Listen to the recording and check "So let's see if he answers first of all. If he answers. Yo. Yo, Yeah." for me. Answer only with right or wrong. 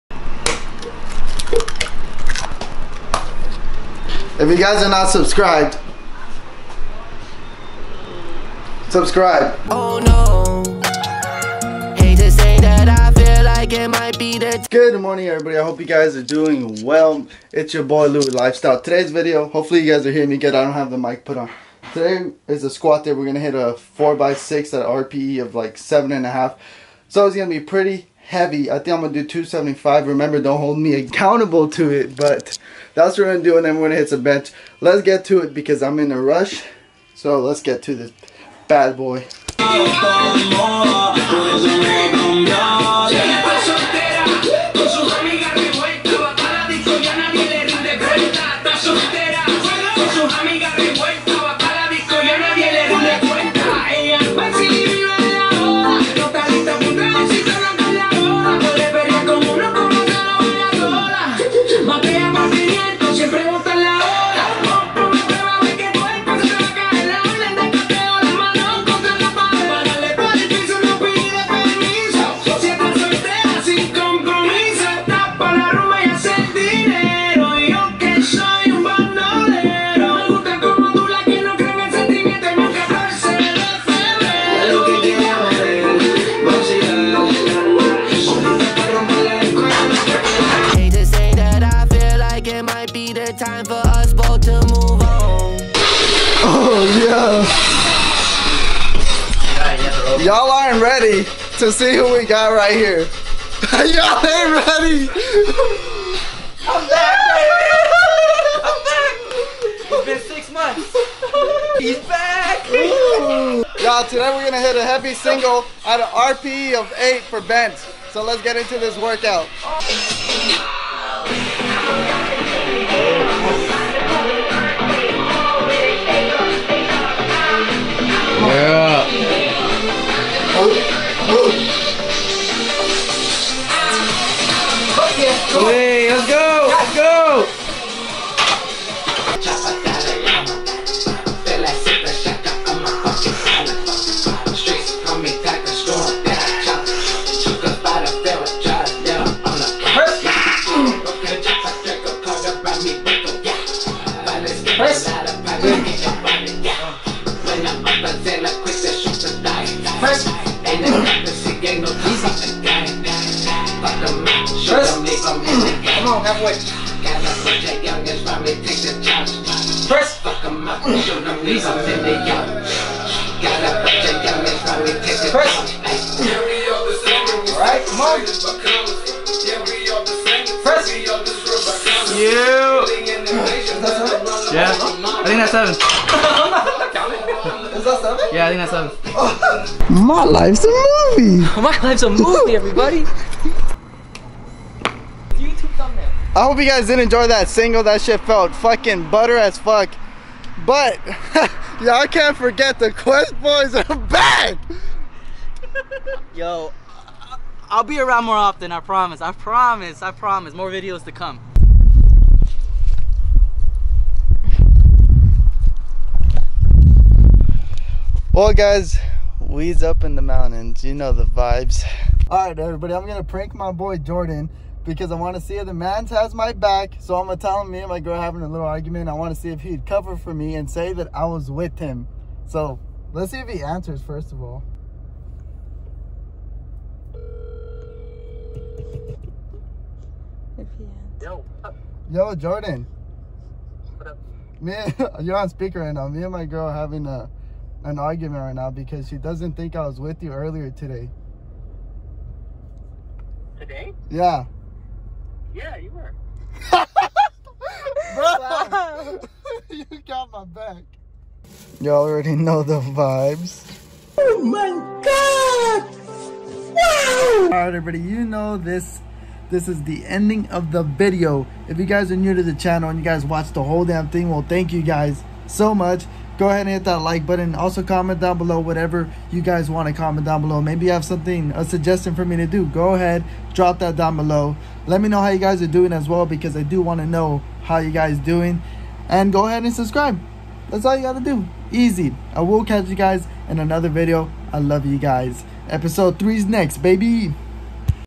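wrong.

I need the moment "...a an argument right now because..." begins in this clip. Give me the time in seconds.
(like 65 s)
247 s.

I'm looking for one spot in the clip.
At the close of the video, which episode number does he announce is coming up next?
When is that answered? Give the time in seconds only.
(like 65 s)
295 s.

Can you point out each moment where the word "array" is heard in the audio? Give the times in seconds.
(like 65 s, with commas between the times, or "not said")
not said.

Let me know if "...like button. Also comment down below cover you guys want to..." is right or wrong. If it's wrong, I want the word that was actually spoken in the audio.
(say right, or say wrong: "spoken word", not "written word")
wrong: "whatever", not "cover".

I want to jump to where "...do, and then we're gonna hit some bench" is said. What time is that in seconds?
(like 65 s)
33 s.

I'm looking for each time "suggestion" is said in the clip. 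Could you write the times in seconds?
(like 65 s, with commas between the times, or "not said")
281 s.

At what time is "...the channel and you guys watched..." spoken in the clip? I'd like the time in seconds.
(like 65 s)
272 s.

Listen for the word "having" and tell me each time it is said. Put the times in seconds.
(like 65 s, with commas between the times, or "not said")
228 s, 246 s.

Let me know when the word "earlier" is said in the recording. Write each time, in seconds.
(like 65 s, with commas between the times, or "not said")
250 s.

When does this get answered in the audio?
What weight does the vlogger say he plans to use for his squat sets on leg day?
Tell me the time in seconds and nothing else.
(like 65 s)
29 s.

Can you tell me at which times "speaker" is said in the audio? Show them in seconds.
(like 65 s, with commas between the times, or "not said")
245 s.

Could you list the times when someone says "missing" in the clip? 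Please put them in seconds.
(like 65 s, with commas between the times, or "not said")
not said.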